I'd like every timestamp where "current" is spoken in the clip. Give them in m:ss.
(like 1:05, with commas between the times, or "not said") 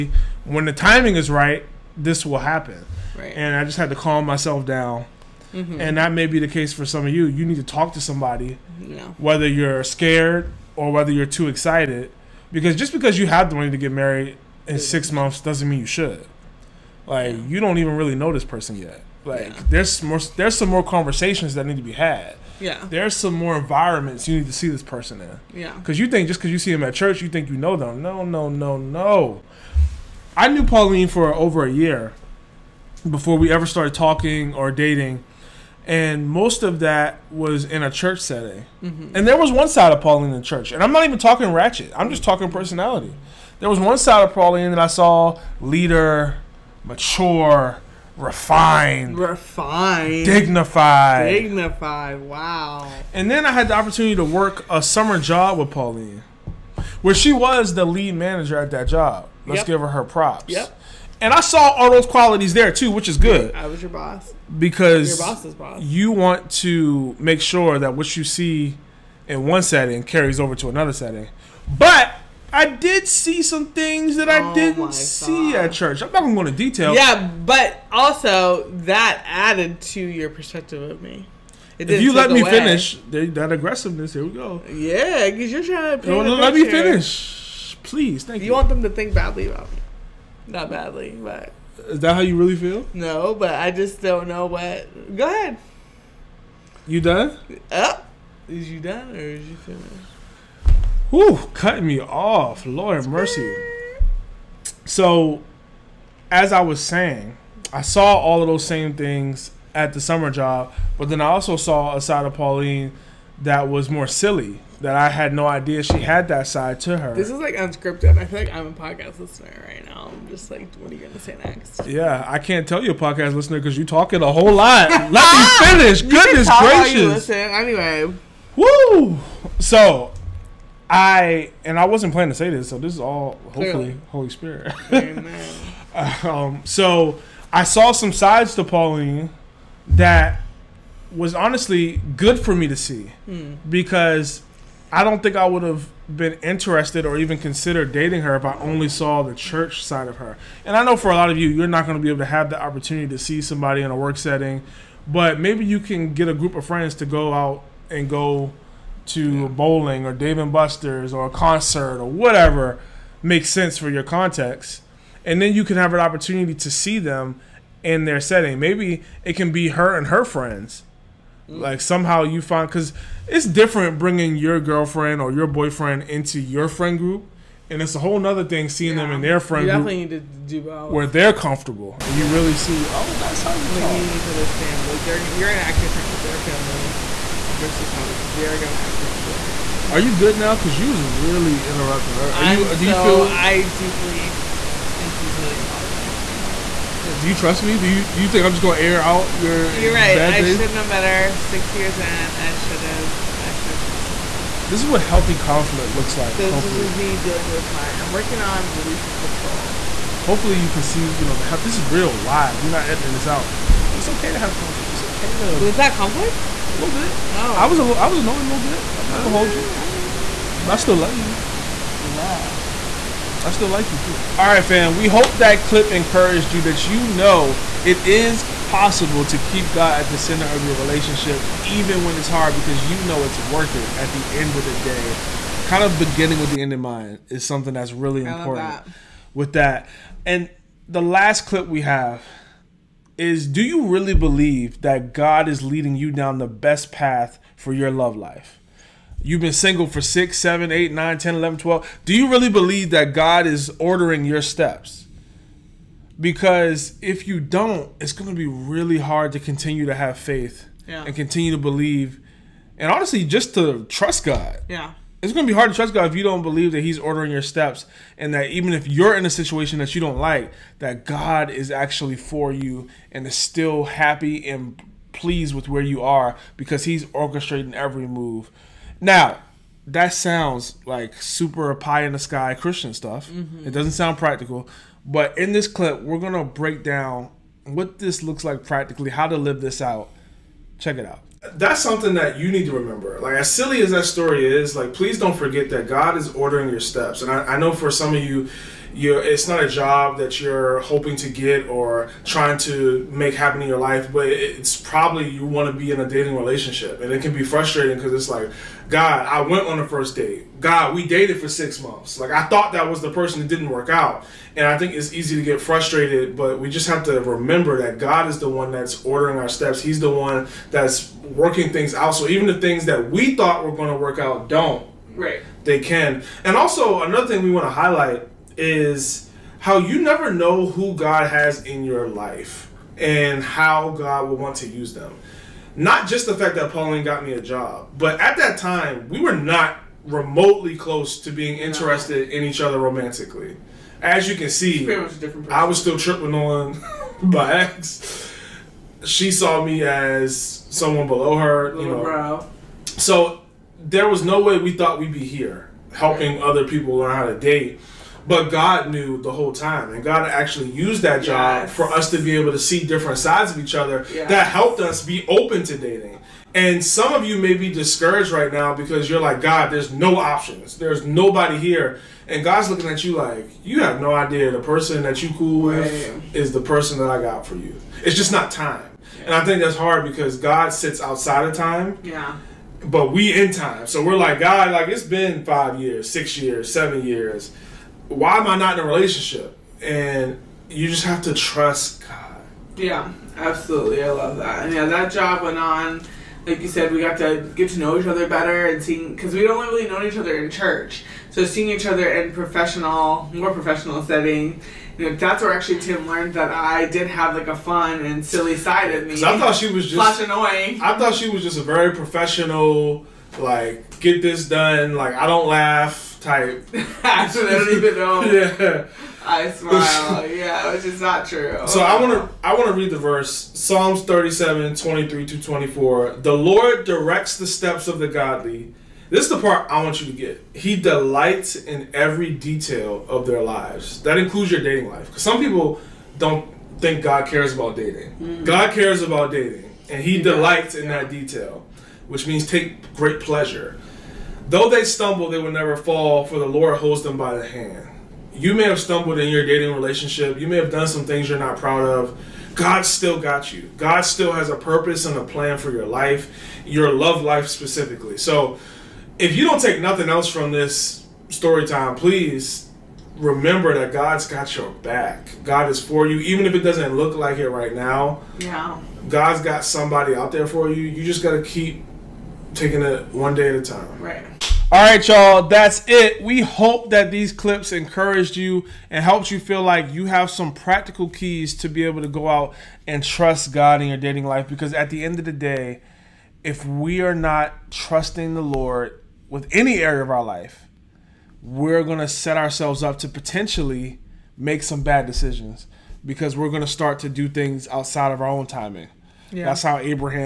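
not said.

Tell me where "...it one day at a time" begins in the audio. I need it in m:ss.
7:52.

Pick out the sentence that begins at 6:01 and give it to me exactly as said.
for us to be able to see different sides of each other yes.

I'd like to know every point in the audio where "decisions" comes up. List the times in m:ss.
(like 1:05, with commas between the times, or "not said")
8:15.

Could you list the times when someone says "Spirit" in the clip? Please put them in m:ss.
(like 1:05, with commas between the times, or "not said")
2:14.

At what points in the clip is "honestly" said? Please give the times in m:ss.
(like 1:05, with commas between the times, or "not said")
2:21, 4:22.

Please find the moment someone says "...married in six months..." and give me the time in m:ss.
0:13.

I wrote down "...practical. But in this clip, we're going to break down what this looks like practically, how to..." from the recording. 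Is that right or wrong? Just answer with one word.
right.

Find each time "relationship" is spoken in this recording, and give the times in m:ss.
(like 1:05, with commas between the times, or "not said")
3:50, 5:06, 6:28, 7:29.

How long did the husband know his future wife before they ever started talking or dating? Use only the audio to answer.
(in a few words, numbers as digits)
Over a year.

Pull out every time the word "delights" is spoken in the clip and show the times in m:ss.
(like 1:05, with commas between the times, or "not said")
7:10, 7:20.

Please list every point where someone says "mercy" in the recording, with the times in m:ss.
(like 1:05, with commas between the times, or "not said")
1:43.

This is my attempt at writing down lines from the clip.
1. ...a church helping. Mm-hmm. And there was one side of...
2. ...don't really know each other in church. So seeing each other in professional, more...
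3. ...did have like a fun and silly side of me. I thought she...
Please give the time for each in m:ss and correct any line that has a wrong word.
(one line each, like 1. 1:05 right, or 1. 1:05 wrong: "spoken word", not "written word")
1. 0:37 wrong: "setting", not "helping"
2. 6:39 right
3. 6:46 right.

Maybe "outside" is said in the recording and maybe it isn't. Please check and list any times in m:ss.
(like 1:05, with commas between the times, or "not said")
6:21, 8:17.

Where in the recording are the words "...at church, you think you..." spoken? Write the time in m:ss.
0:26.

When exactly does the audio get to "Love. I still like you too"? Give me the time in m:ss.
3:42.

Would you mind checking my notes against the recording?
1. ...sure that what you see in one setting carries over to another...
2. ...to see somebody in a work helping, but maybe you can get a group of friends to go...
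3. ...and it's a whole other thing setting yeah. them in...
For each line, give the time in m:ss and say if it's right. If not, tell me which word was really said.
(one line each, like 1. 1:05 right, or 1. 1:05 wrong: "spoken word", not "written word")
1. 1:07 right
2. 2:33 wrong: "setting", not "helping"
3. 2:57 wrong: "seeing", not "setting".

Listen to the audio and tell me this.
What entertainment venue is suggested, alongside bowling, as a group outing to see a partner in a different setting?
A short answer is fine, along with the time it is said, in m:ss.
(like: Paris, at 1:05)
Dave and Buster's, at 2:40.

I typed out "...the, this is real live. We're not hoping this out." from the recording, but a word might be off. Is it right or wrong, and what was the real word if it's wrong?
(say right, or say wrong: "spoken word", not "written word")
wrong: "editing", not "hoping".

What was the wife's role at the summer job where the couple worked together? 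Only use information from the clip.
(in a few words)
Lead manager.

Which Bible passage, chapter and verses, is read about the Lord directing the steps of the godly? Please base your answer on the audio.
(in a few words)
Psalms 37:23-24.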